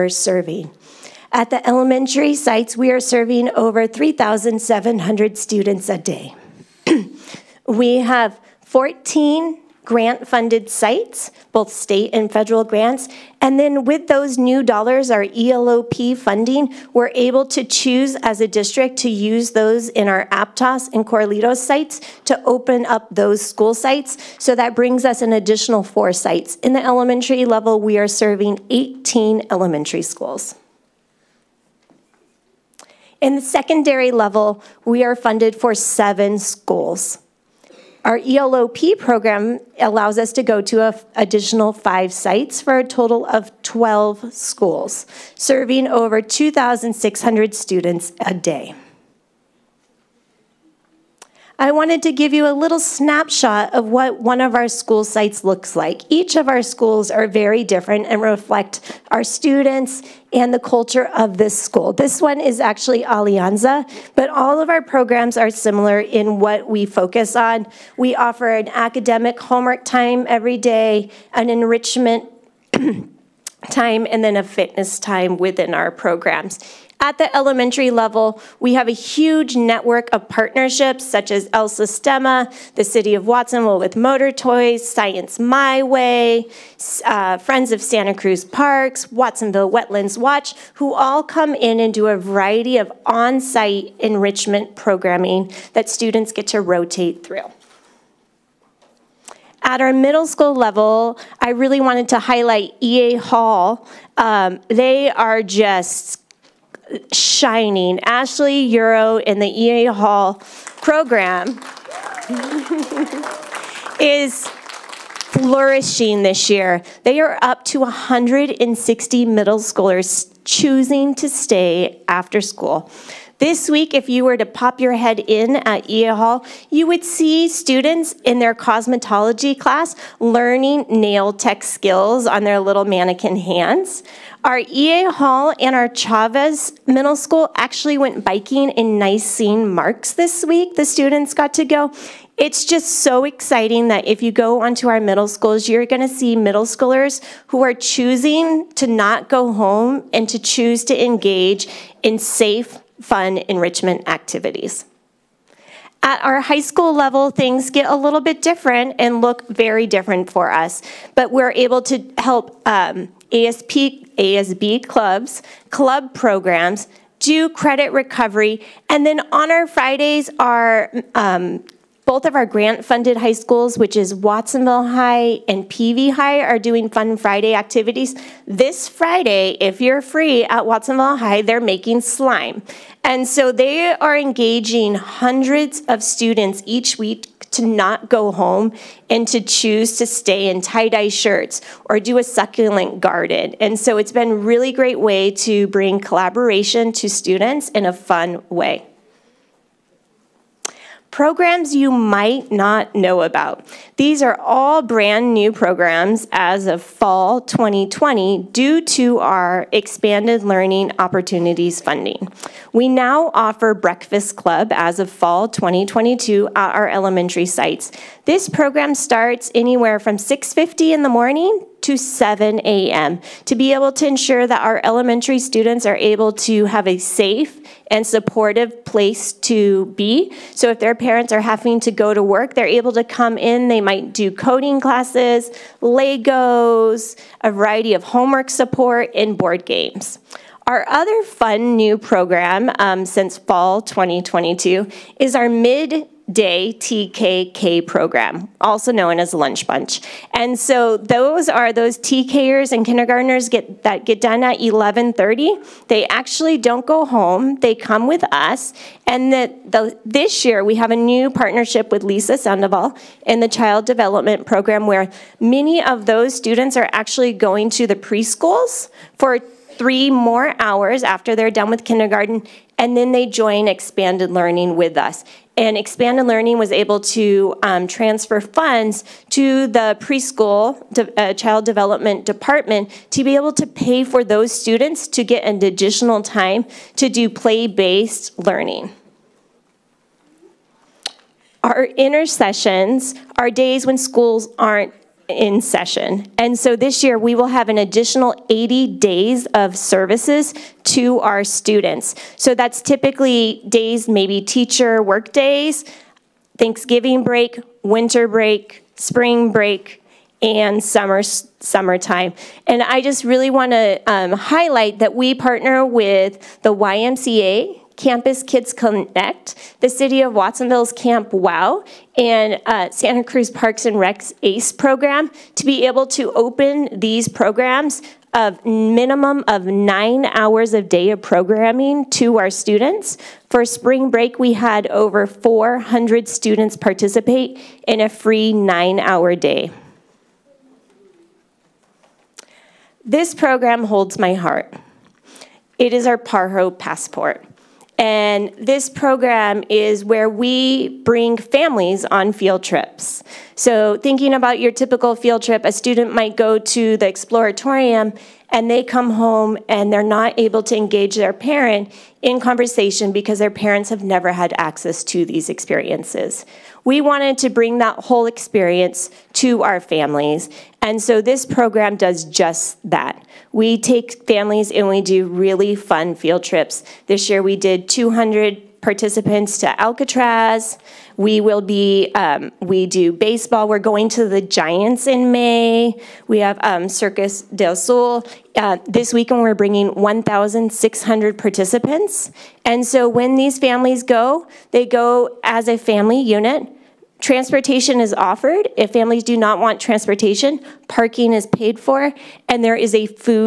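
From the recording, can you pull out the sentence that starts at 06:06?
We wanted to bring that whole experience to our families.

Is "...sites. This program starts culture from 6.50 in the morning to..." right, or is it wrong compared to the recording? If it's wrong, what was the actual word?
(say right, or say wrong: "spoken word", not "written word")
wrong: "anywhere", not "culture".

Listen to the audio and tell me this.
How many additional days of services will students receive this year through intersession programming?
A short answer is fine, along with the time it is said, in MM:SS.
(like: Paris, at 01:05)
80, at 04:58.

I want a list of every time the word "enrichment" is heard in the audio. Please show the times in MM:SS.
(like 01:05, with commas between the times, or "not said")
01:11, 01:34, 02:33.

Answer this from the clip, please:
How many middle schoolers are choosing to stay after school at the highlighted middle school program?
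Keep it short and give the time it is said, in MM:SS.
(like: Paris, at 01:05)
160, at 01:57.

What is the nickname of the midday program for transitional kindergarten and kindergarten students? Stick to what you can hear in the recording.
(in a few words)
Lunch Bunch.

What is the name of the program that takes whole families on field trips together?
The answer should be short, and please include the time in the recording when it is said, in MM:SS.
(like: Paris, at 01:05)
Pajaro passport, at 05:46.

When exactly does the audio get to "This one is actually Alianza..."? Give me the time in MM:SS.
01:01.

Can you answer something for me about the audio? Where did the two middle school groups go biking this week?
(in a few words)
Nisene Marks.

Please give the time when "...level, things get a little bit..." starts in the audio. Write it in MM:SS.
02:36.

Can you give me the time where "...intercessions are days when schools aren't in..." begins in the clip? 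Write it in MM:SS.
04:51.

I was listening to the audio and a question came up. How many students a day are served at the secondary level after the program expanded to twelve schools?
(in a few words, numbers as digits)
over 2,600.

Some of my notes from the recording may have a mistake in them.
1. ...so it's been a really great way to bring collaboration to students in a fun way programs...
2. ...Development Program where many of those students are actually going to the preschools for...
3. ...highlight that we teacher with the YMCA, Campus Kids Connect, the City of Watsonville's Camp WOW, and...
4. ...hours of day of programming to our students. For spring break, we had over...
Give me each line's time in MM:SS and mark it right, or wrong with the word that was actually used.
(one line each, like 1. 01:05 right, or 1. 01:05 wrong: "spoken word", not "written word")
1. 03:13 right
2. 04:23 right
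3. 05:14 wrong: "partner", not "teacher"
4. 05:30 right.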